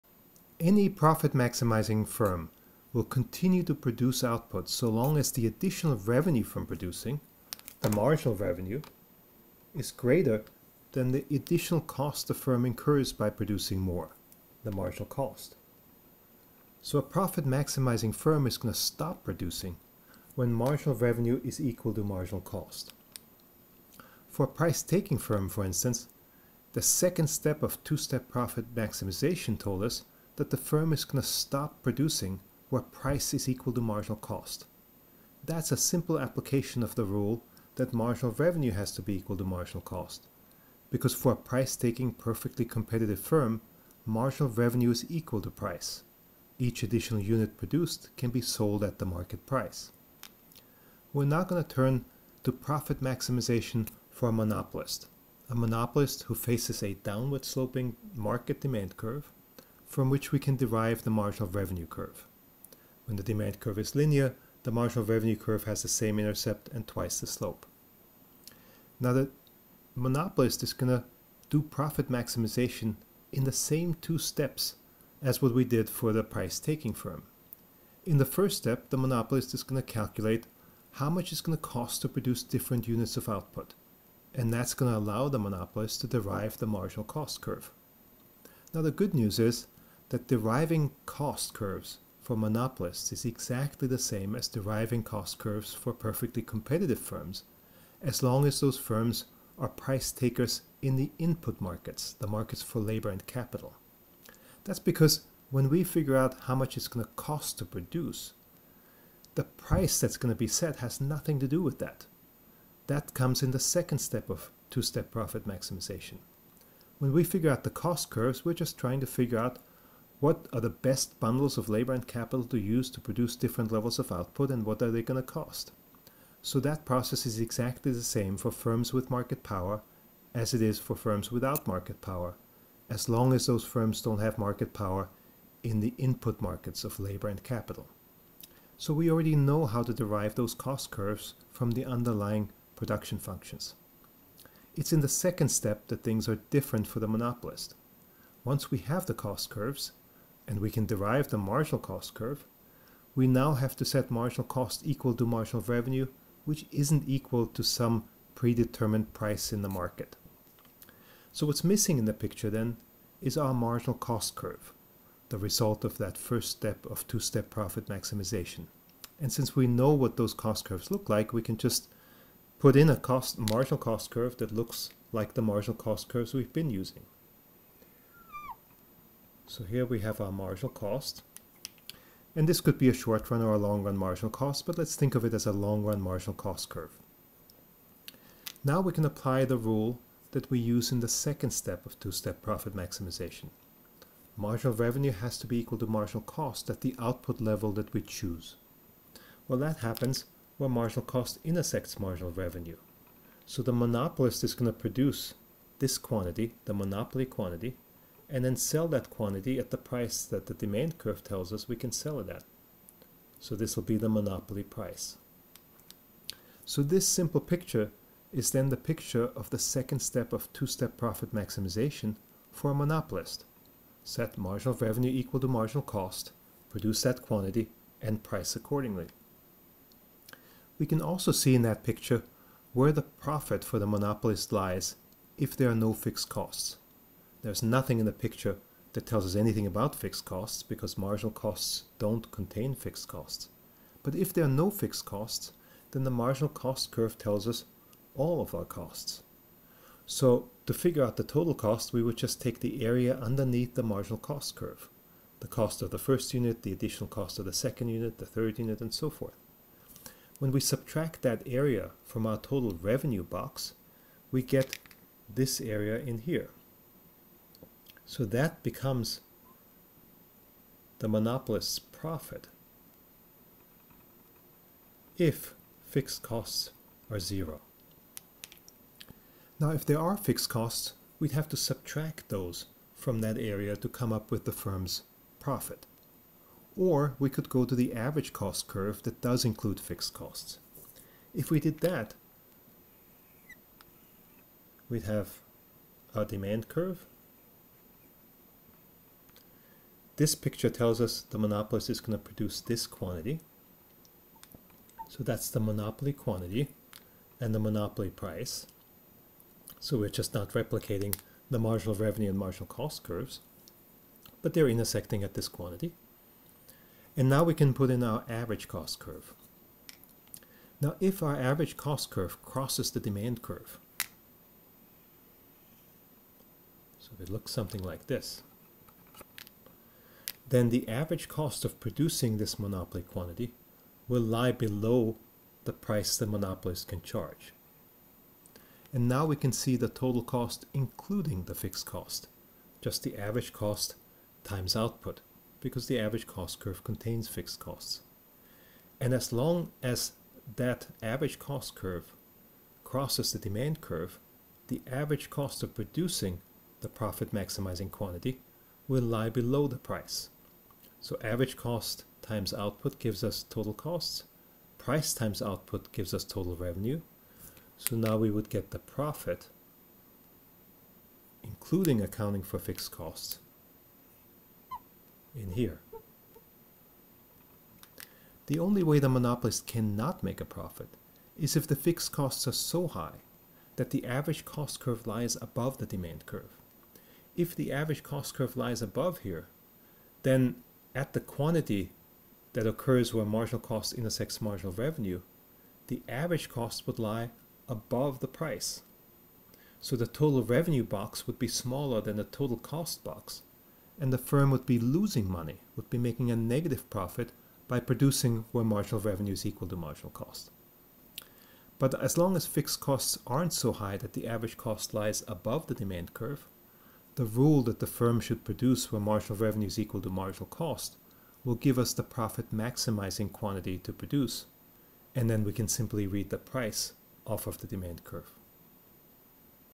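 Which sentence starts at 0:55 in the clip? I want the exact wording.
A monopolist who faces a downward sloping market demand curve from which we can derive the marginal revenue curve.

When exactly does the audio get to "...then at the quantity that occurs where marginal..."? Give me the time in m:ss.
6:30.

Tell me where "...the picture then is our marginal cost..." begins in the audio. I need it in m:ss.
2:42.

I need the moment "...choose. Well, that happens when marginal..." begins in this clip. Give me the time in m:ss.
3:17.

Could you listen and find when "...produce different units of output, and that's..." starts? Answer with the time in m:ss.
1:22.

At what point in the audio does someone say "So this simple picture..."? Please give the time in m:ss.
3:36.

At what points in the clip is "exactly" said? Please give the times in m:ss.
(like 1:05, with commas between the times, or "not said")
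1:33, 2:07.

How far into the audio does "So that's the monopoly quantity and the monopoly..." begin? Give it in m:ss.
5:05.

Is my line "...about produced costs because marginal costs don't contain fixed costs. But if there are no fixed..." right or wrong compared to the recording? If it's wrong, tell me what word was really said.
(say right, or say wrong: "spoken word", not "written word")
wrong: "fixed", not "produced".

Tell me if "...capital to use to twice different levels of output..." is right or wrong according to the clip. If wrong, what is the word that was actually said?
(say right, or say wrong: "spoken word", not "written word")
wrong: "produce", not "twice".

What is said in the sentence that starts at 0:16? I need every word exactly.
So a profit maximizing firm is going to stop producing when marginal revenue is equal to marginal cost.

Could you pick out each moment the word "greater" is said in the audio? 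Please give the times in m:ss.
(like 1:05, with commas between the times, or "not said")
0:09.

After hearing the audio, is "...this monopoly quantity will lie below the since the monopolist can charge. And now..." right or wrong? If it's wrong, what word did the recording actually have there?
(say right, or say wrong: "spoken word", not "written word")
wrong: "price", not "since".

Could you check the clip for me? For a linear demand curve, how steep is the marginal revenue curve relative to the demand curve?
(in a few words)
twice the slope.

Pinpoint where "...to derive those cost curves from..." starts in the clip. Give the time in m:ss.
2:19.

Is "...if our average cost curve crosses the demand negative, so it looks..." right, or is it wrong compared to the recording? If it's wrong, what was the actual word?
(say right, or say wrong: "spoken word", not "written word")
wrong: "curve", not "negative".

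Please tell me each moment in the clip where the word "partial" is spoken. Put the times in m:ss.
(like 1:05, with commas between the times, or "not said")
not said.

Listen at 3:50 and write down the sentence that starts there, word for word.
We can also see in that picture where the profit for the monopolist lies if there are no fixed costs.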